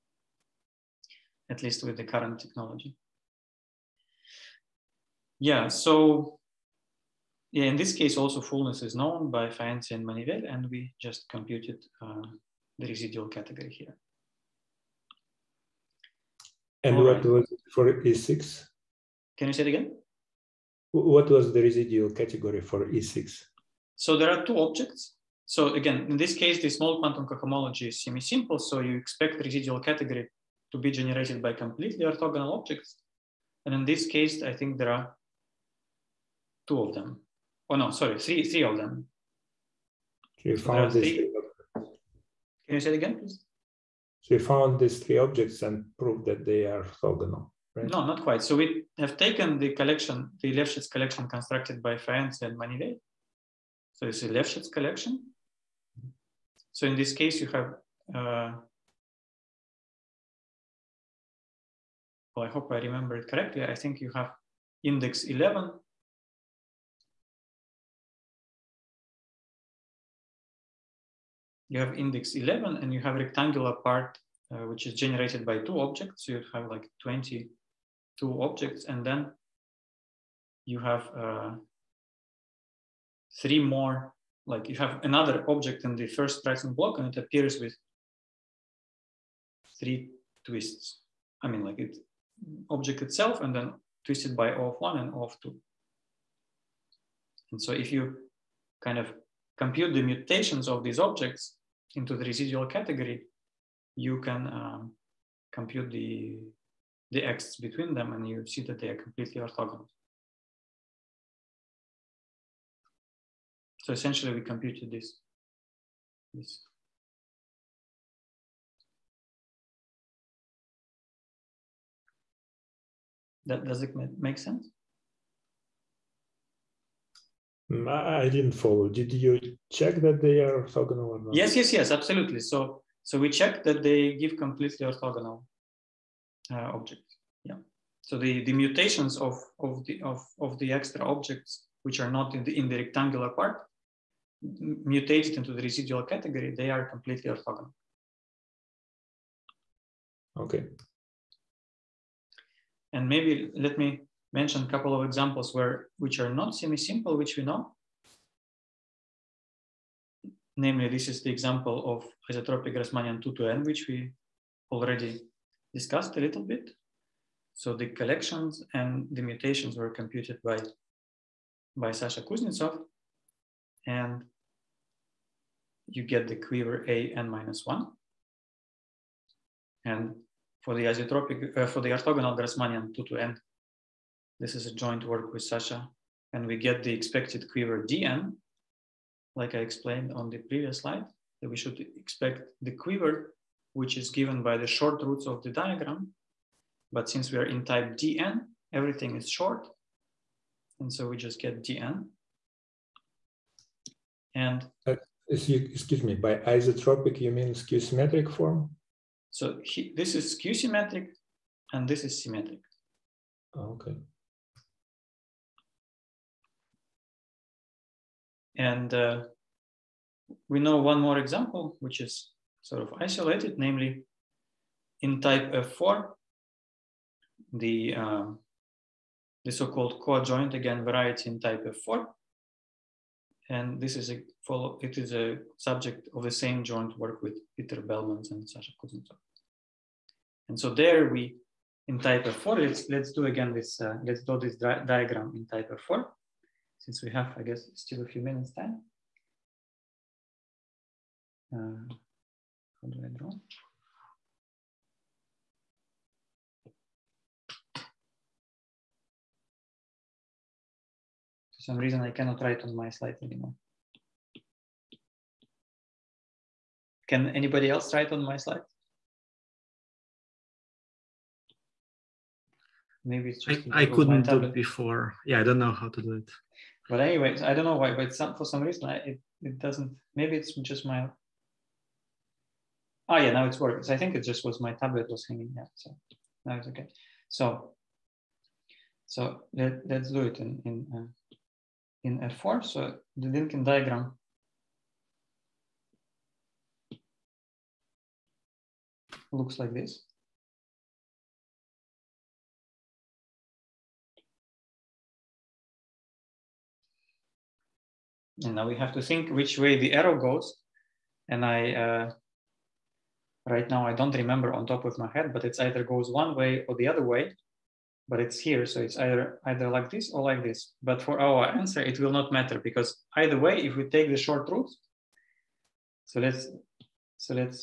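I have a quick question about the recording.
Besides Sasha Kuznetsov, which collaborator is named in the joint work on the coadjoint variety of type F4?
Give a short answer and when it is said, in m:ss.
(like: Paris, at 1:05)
Peter Belmans, at 3:57.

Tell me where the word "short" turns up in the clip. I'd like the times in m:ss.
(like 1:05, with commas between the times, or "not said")
3:14, 3:19, 5:24.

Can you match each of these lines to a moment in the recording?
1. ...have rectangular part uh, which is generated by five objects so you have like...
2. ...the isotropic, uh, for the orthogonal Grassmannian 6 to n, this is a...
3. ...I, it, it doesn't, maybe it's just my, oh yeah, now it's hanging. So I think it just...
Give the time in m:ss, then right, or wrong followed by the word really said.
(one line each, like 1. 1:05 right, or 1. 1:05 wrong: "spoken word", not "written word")
1. 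1:13 wrong: "two", not "five"
2. 3:00 wrong: "2", not "6"
3. 4:38 wrong: "working", not "hanging".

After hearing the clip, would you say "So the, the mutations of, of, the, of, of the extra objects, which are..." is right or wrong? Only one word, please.
right.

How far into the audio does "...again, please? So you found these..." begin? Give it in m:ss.
0:42.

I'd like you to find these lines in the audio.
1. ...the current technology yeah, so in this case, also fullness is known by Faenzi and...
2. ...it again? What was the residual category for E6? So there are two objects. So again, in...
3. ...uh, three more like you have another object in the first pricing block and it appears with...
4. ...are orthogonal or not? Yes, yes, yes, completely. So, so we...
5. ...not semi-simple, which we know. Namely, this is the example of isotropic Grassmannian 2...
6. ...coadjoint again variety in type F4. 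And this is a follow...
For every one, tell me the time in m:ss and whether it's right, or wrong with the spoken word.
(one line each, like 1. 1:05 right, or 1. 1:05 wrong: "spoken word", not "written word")
1. 0:01 right
2. 0:19 right
3. 1:21 right
4. 2:10 wrong: "absolutely", not "completely"
5. 2:36 right
6. 3:50 right.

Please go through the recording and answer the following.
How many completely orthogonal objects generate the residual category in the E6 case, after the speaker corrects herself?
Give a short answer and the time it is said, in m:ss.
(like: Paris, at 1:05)
3, at 0:38.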